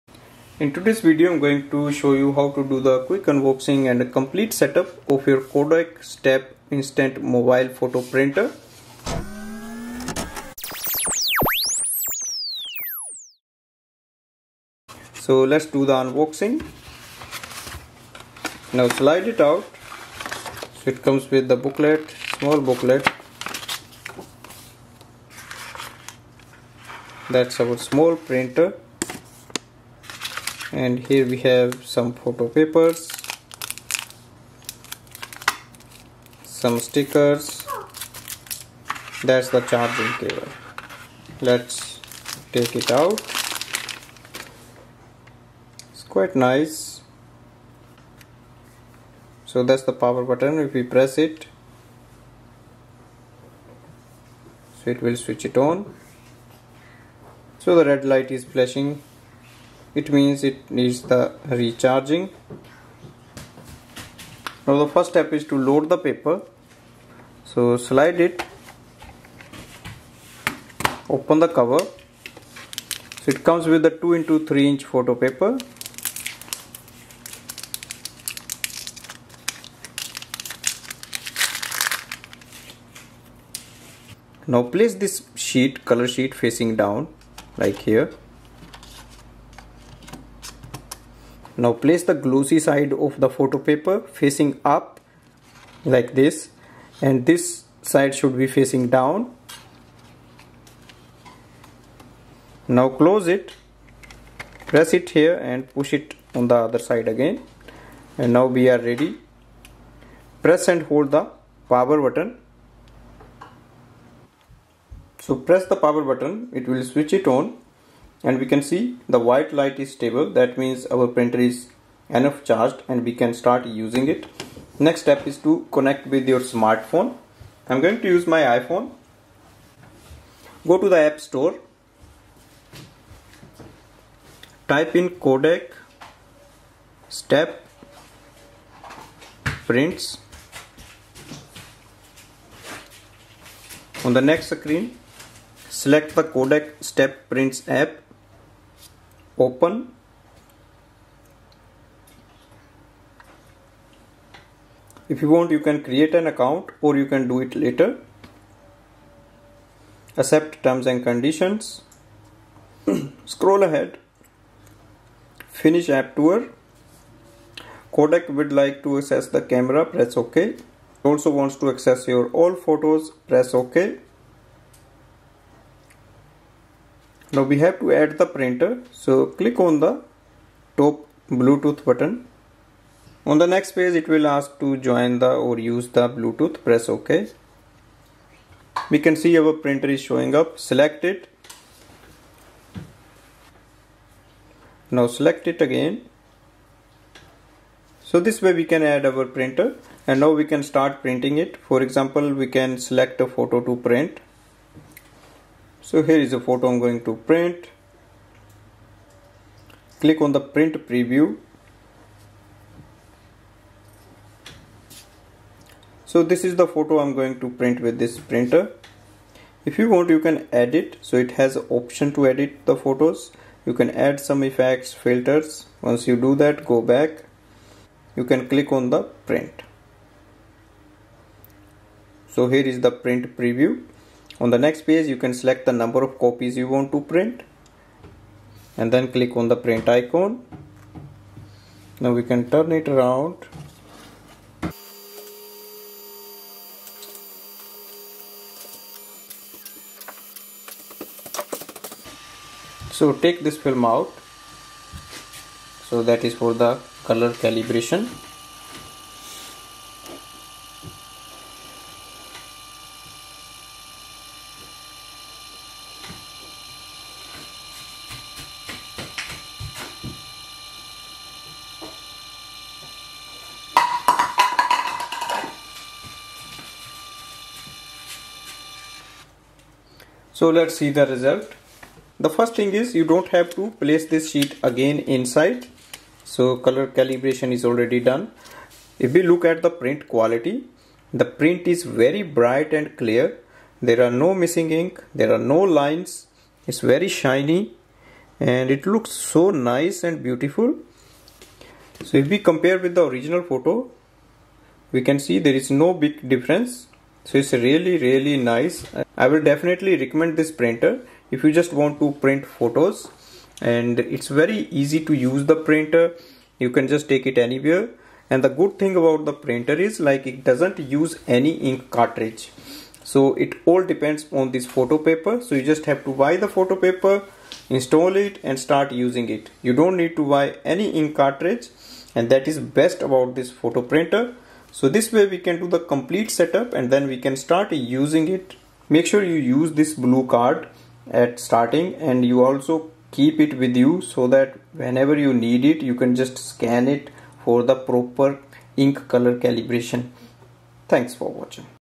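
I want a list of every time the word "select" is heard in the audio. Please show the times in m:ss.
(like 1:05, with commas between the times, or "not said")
2:25, 3:10, 3:15, 3:22, 3:55.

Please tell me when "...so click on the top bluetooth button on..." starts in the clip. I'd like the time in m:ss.
2:58.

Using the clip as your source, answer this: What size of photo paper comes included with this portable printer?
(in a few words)
2 by 3 inch.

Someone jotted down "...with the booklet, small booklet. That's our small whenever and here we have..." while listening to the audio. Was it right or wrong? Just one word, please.
wrong.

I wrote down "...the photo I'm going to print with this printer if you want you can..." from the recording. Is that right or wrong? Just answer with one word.
right.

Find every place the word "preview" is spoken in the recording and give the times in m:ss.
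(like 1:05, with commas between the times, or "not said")
3:30, 3:53.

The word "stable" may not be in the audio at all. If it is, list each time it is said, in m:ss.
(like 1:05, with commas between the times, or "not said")
1:59.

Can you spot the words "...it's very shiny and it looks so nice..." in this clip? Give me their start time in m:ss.
4:56.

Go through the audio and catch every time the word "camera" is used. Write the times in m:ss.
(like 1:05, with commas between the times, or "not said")
2:49.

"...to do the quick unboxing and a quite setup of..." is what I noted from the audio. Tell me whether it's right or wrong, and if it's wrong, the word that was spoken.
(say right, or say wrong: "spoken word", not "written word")
wrong: "complete", not "quite".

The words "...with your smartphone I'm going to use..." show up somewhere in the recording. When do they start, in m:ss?
2:06.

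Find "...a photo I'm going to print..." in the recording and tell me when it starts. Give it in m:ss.
3:26.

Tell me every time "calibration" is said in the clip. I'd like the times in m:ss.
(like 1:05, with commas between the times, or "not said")
4:17, 4:46, 5:49.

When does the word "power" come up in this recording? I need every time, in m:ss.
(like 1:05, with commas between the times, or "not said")
0:49, 1:51, 1:55.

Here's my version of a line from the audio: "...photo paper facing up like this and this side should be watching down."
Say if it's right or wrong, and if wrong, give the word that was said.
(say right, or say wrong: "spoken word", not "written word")
wrong: "facing", not "watching".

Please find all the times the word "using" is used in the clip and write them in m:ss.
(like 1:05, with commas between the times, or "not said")
2:03, 5:28, 5:37.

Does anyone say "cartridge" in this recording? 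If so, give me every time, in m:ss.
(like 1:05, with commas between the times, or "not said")
5:21, 5:31.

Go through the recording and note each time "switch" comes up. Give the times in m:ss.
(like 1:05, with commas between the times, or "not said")
0:55, 1:56.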